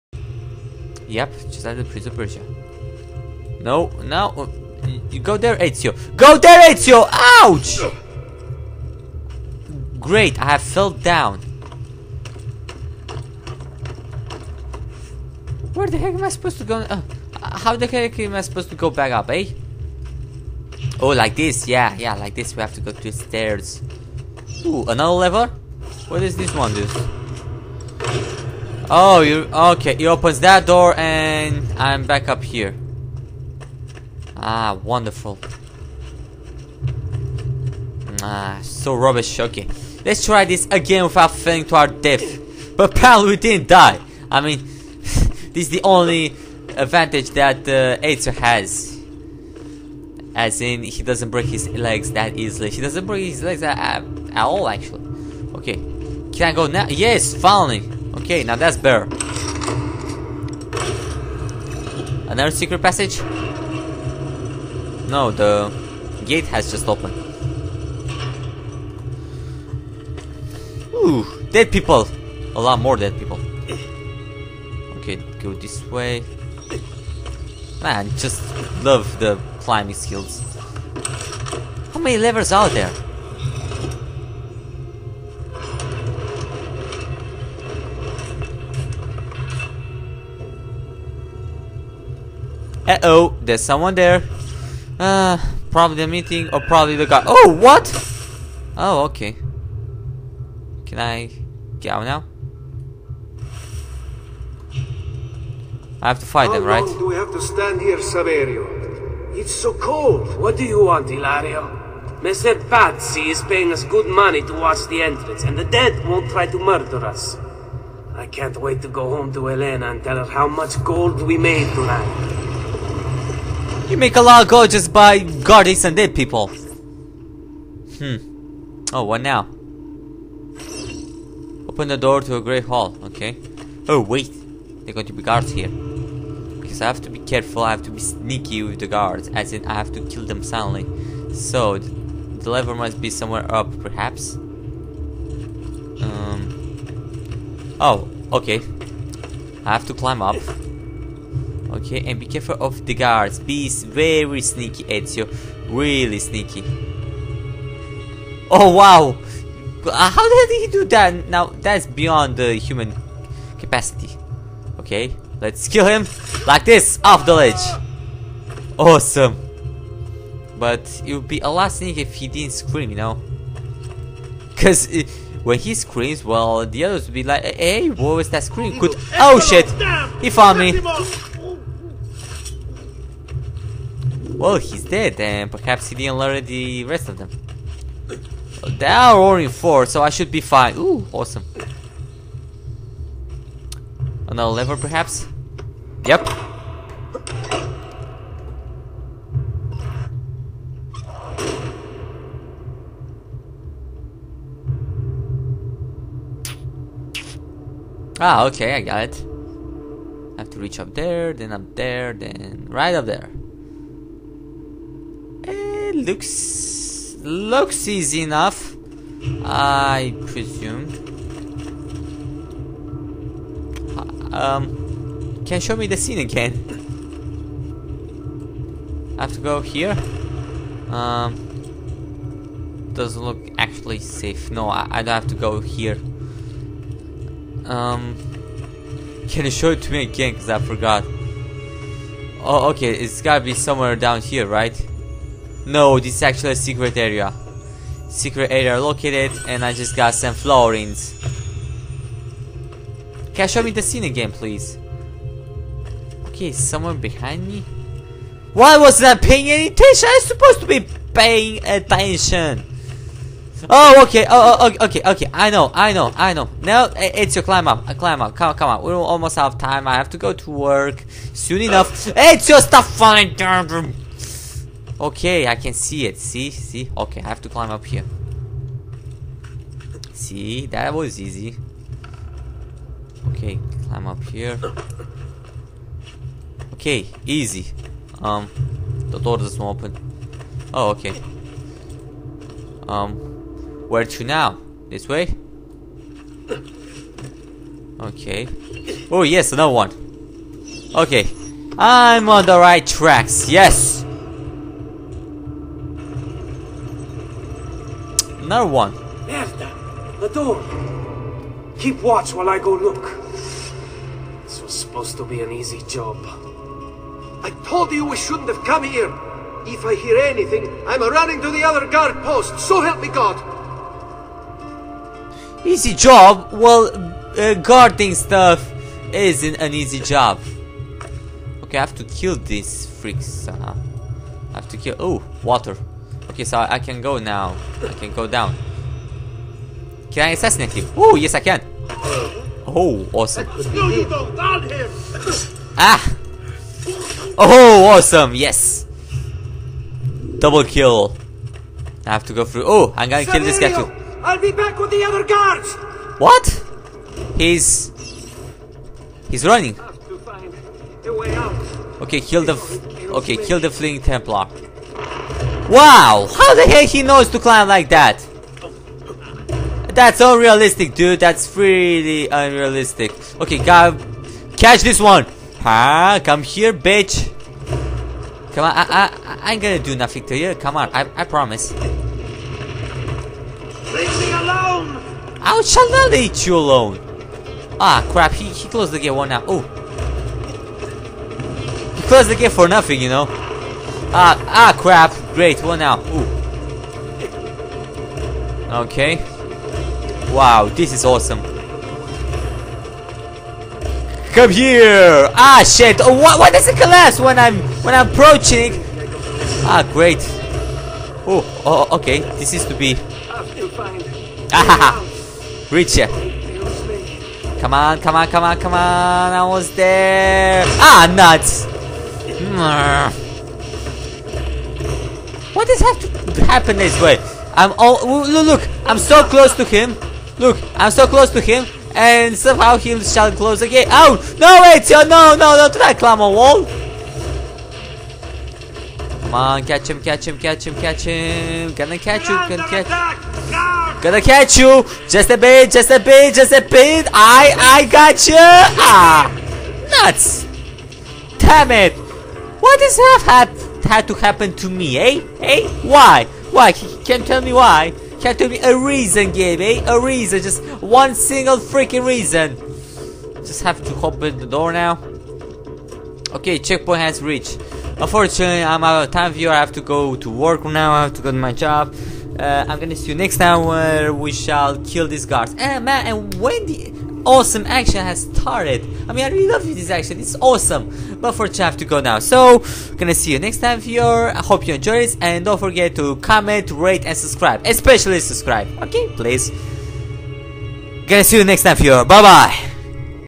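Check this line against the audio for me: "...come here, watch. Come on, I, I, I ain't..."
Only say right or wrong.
wrong.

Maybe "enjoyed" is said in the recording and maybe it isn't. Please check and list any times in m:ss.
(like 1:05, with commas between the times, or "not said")
8:04.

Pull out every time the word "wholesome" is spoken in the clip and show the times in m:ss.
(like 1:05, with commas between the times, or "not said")
not said.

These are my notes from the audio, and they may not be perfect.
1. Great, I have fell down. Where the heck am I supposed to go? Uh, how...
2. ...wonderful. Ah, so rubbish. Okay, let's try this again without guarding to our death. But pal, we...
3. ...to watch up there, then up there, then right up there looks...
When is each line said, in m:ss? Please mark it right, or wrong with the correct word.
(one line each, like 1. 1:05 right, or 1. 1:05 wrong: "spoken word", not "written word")
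1. 0:09 right
2. 0:34 wrong: "falling", not "guarding"
3. 3:30 wrong: "reach", not "watch".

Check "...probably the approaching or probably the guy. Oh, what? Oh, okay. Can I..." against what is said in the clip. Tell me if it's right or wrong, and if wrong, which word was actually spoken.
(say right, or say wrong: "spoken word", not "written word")
wrong: "meeting", not "approaching".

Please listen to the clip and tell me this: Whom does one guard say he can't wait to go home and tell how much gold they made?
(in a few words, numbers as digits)
Elena.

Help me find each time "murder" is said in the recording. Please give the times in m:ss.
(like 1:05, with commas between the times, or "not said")
1:56.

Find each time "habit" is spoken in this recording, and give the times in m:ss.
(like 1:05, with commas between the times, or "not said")
not said.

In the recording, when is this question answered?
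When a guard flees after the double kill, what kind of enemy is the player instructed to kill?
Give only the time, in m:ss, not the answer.
6:03.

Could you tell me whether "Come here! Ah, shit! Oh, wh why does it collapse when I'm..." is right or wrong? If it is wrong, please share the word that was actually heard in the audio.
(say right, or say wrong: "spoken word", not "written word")
right.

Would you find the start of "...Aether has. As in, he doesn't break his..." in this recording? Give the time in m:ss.
0:48.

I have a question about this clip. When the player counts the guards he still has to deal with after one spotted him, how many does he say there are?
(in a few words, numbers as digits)
4.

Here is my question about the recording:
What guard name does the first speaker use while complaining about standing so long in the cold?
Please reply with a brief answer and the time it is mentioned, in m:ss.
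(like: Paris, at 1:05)
Saverio, at 1:47.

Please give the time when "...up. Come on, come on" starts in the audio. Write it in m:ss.
4:28.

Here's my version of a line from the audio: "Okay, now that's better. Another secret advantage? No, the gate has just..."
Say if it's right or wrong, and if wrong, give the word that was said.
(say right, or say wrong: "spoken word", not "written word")
wrong: "passage", not "advantage".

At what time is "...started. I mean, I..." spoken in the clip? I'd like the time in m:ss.
7:58.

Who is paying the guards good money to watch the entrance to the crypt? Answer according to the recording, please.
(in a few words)
Messer Pazzi.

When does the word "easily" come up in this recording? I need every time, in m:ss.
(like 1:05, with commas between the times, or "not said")
0:52.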